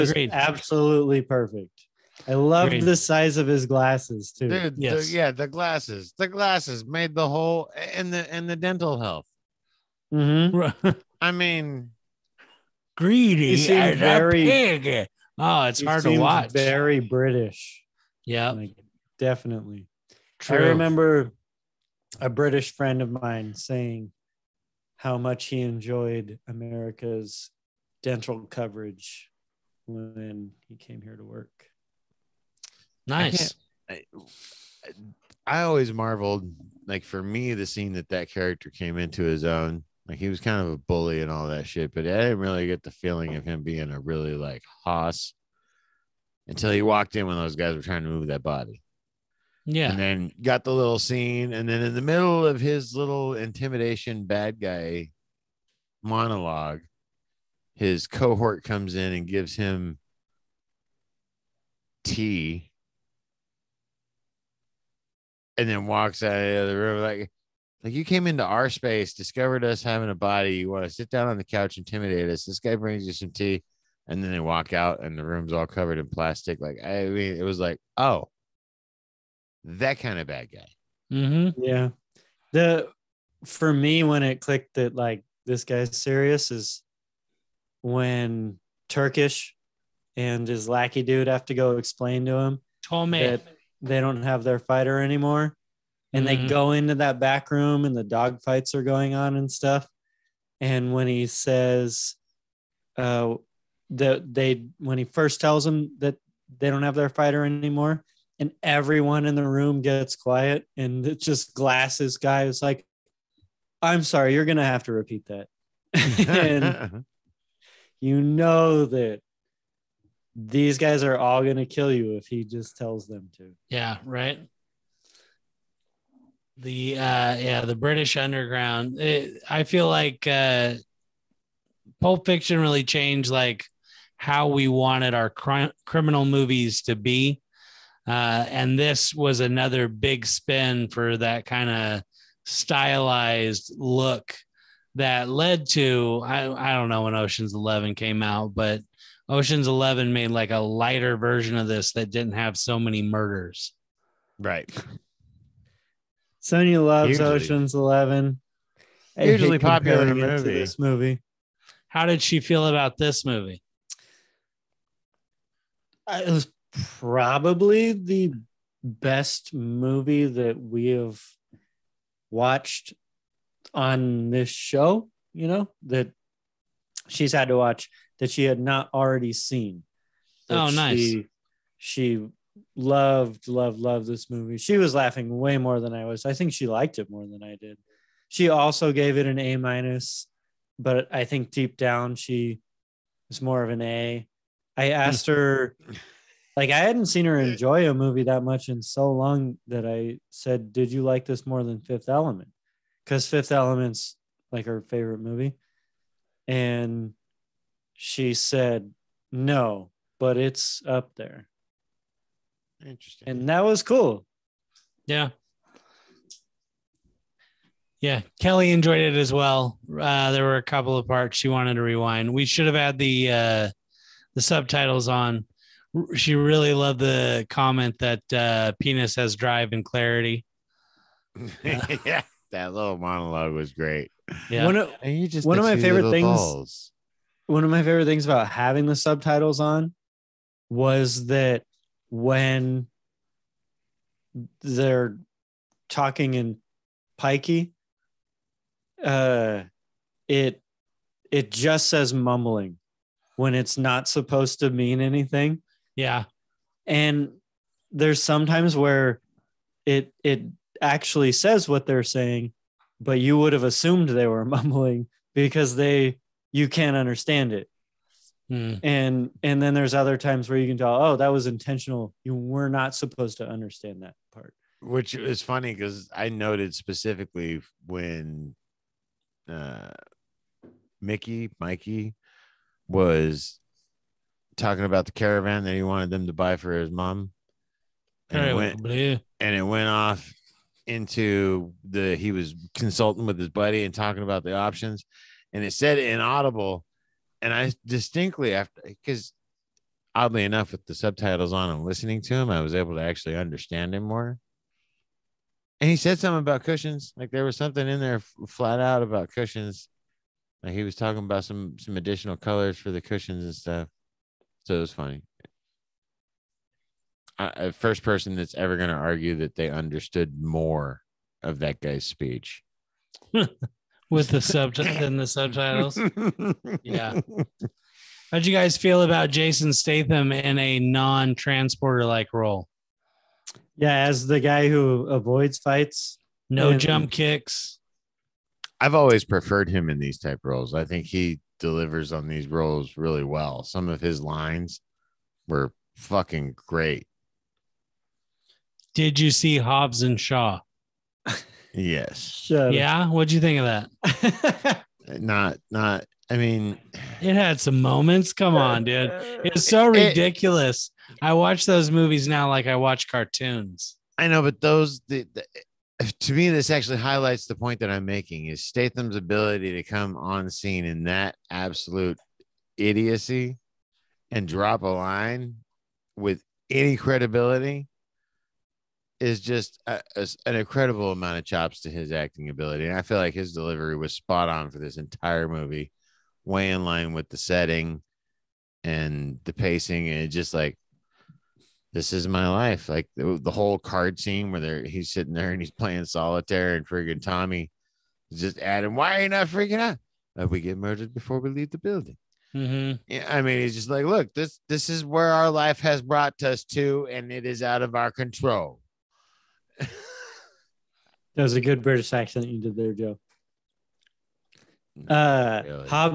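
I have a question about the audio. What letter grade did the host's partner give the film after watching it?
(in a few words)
A minus.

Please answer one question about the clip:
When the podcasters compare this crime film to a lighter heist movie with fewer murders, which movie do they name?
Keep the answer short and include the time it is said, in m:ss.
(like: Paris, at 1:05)
Ocean's 11, at 2:29.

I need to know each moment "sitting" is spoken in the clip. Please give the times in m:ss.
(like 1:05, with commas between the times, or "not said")
6:35.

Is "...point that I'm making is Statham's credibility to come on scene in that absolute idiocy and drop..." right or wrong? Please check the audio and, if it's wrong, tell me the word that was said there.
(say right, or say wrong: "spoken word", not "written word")
wrong: "ability", not "credibility".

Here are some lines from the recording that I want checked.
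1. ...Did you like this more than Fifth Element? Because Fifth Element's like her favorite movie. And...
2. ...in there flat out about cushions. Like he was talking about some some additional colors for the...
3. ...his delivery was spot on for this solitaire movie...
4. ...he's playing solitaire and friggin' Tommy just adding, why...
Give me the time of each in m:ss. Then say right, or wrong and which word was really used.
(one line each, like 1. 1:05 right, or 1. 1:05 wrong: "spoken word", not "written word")
1. 3:20 right
2. 5:07 right
3. 6:23 wrong: "entire", not "solitaire"
4. 6:35 right.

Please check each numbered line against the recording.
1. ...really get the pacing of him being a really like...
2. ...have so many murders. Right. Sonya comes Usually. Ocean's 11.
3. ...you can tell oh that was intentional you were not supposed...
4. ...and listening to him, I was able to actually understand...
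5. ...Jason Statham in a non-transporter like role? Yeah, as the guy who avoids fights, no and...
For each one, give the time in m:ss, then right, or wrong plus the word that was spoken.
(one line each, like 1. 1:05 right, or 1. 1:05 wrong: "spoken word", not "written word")
1. 0:42 wrong: "feeling", not "pacing"
2. 2:32 wrong: "loves", not "comes"
3. 4:30 right
4. 5:01 right
5. 5:29 right.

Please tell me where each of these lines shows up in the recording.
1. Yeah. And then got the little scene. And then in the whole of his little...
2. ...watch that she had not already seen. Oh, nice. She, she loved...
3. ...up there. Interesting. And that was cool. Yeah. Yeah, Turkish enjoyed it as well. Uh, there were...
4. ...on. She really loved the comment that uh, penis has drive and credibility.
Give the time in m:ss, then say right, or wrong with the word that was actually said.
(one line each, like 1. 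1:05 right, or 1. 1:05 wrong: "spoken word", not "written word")
1. 0:49 wrong: "middle", not "whole"
2. 2:57 right
3. 3:30 wrong: "Kelly", not "Turkish"
4. 3:45 wrong: "clarity", not "credibility".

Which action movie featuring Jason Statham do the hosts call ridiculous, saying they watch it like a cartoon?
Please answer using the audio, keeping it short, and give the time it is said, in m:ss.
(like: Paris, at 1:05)
Hobbs and Shaw, at 5:49.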